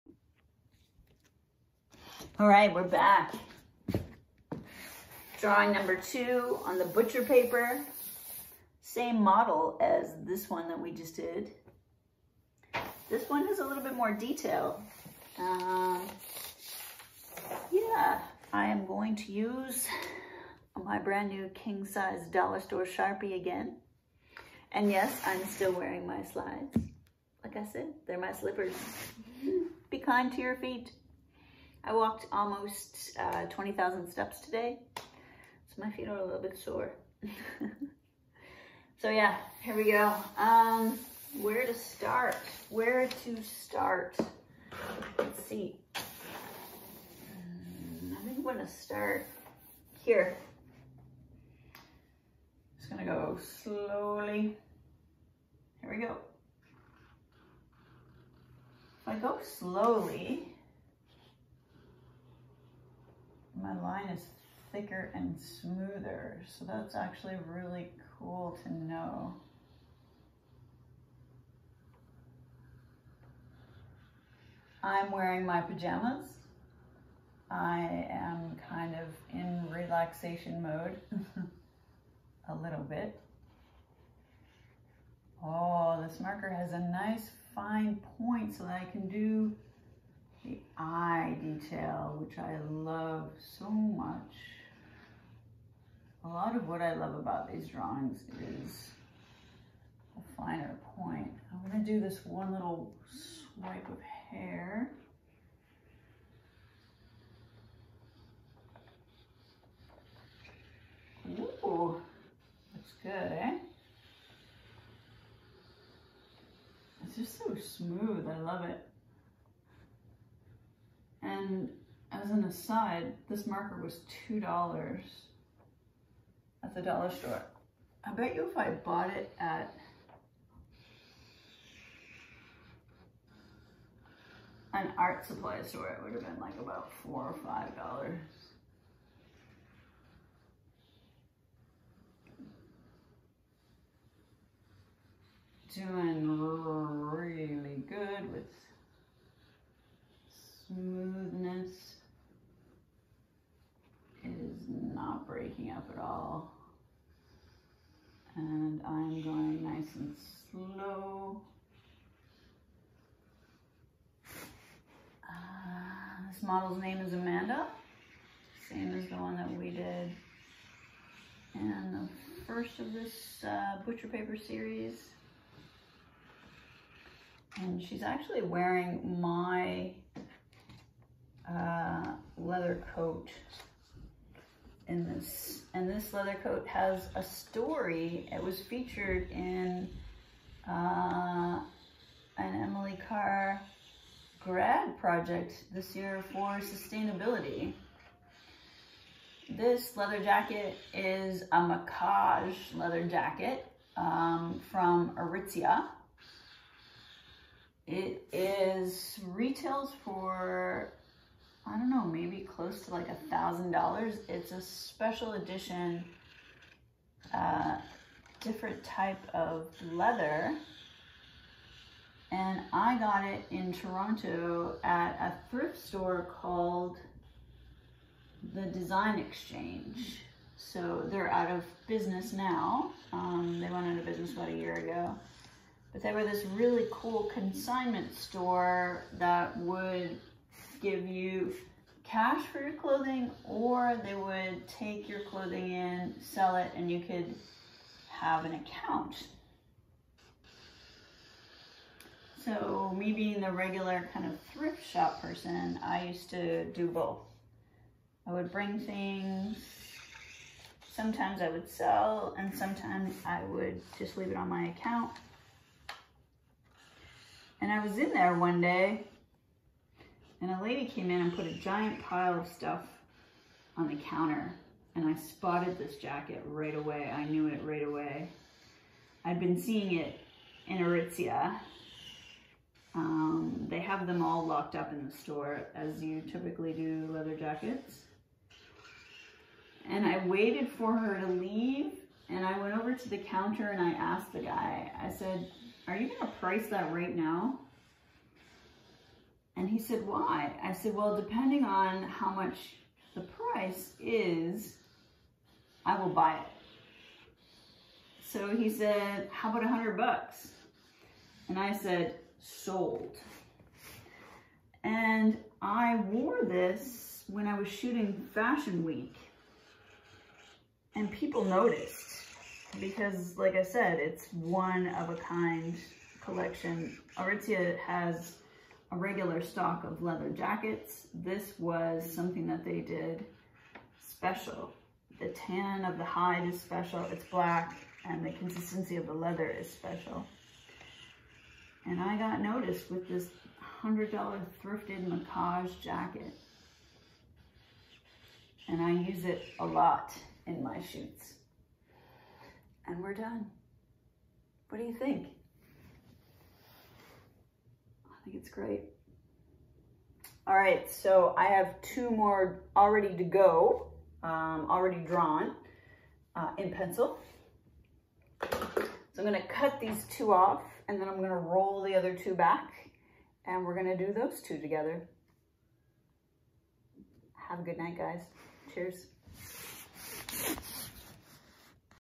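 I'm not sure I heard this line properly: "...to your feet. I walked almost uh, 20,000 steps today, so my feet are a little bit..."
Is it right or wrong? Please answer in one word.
right.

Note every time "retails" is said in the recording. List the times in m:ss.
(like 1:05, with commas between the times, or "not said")
3:29.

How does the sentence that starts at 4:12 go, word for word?
So me being the regular kind of thrift shop person, I used to do both.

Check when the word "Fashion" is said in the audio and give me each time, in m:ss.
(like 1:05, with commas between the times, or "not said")
5:18.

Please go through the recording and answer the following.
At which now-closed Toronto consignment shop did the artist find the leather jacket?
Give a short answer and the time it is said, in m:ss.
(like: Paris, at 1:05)
Design Exchange, at 3:48.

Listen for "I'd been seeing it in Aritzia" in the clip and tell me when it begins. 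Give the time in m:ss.
4:39.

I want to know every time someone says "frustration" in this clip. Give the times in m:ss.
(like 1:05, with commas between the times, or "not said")
not said.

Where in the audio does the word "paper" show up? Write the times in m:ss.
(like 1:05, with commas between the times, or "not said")
0:07, 2:54.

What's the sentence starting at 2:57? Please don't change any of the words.
And she's actually wearing my uh, leather coat in this this leather coat has a story.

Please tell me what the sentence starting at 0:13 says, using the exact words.
This one has a little bit more detail.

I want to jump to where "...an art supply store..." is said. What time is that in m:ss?
2:14.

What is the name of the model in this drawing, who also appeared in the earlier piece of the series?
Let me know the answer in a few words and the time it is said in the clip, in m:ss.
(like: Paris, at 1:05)
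Amanda, at 2:47.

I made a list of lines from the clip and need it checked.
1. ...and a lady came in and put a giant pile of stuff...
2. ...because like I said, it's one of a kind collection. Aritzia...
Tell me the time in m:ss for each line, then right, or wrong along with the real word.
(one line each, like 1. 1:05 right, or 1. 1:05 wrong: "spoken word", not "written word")
1. 4:30 right
2. 5:22 right.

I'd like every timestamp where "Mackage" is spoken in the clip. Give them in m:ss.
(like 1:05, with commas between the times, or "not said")
3:21, 5:45.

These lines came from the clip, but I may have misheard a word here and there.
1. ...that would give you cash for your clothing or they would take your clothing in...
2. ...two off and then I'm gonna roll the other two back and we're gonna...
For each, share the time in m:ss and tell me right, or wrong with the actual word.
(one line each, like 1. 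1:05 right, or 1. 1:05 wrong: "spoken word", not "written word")
1. 3:59 right
2. 6:10 right.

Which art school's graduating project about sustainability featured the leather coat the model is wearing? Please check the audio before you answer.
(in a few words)
Emily Carr.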